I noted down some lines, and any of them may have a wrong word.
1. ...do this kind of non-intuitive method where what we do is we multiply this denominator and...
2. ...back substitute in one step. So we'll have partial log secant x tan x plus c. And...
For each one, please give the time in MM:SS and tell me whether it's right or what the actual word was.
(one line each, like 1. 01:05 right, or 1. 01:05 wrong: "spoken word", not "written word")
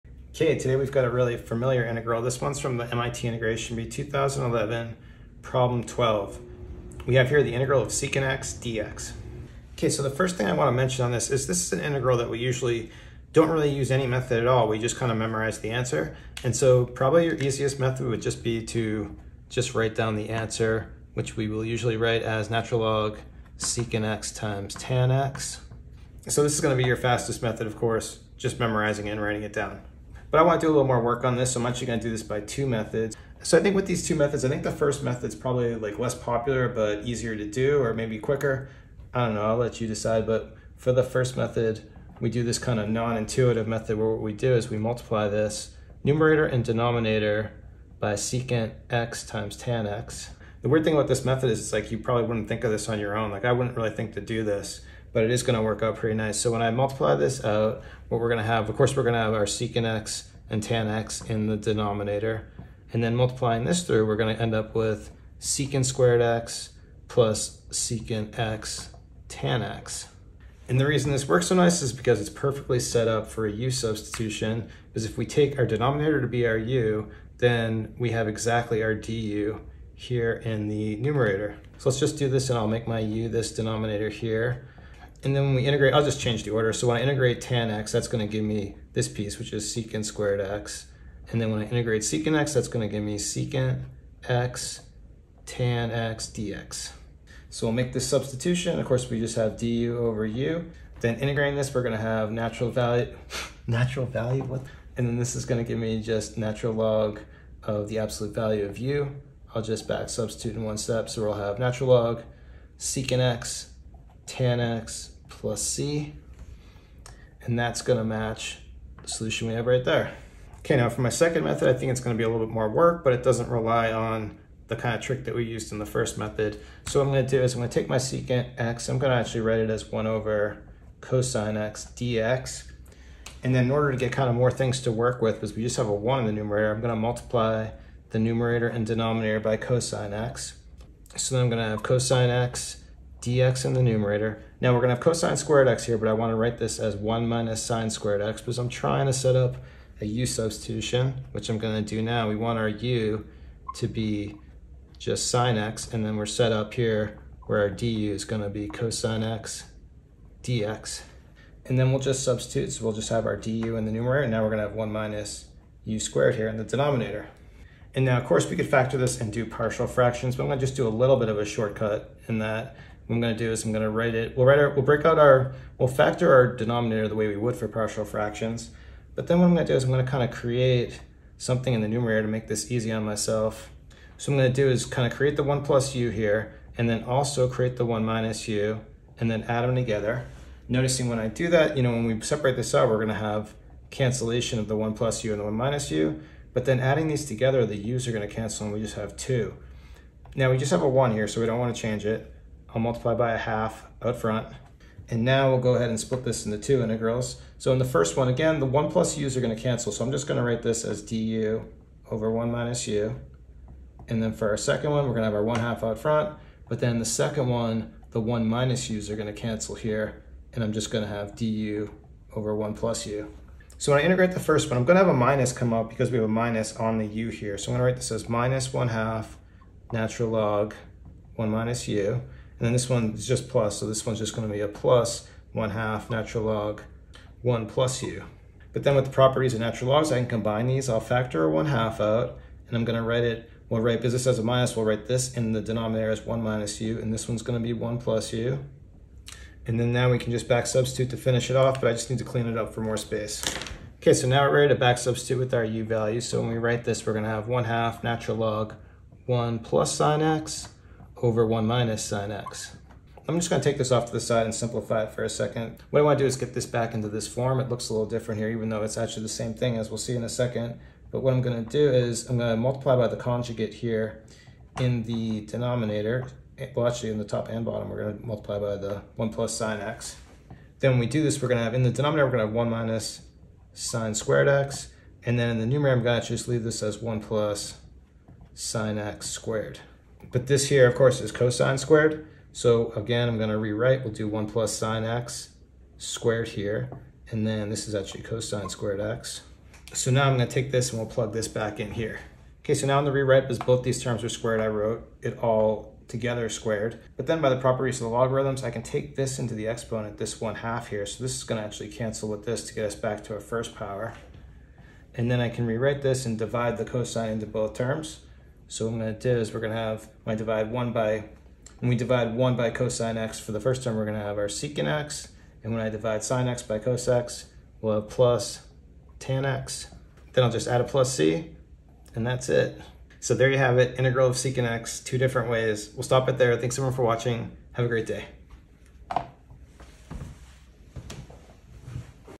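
1. 00:42 wrong: "numerator", not "denominator"
2. 01:49 wrong: "natural", not "partial".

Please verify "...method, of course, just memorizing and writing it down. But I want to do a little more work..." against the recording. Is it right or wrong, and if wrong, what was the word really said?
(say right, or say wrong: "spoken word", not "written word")
right.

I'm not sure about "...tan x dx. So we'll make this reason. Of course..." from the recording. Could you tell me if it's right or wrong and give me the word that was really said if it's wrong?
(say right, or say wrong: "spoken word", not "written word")
wrong: "substitution", not "reason".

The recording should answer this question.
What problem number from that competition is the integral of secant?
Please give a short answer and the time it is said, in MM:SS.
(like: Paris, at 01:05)
12, at 00:05.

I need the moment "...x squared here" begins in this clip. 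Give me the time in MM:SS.
04:55.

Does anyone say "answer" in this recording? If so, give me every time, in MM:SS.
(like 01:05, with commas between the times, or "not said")
00:15, 00:20.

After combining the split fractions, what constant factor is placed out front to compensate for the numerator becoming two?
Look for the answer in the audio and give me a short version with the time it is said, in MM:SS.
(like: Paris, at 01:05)
a half, at 03:23.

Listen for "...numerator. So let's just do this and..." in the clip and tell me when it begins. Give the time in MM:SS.
01:20.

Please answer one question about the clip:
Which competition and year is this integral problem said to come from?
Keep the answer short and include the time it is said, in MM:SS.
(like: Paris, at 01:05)
MIT Integration Bee 2011, at 00:02.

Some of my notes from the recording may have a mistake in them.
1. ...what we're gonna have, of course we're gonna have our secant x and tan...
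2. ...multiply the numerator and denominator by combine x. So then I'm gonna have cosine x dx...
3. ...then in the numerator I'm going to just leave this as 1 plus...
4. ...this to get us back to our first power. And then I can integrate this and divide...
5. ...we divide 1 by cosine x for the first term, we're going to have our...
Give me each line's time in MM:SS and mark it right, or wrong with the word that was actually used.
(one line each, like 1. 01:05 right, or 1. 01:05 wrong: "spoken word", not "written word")
1. 00:58 right
2. 02:16 wrong: "cosine", not "combine"
3. 04:45 right
4. 05:12 wrong: "rewrite", not "integrate"
5. 05:21 right.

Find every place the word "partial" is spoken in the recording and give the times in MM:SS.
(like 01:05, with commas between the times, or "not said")
02:49, 02:57.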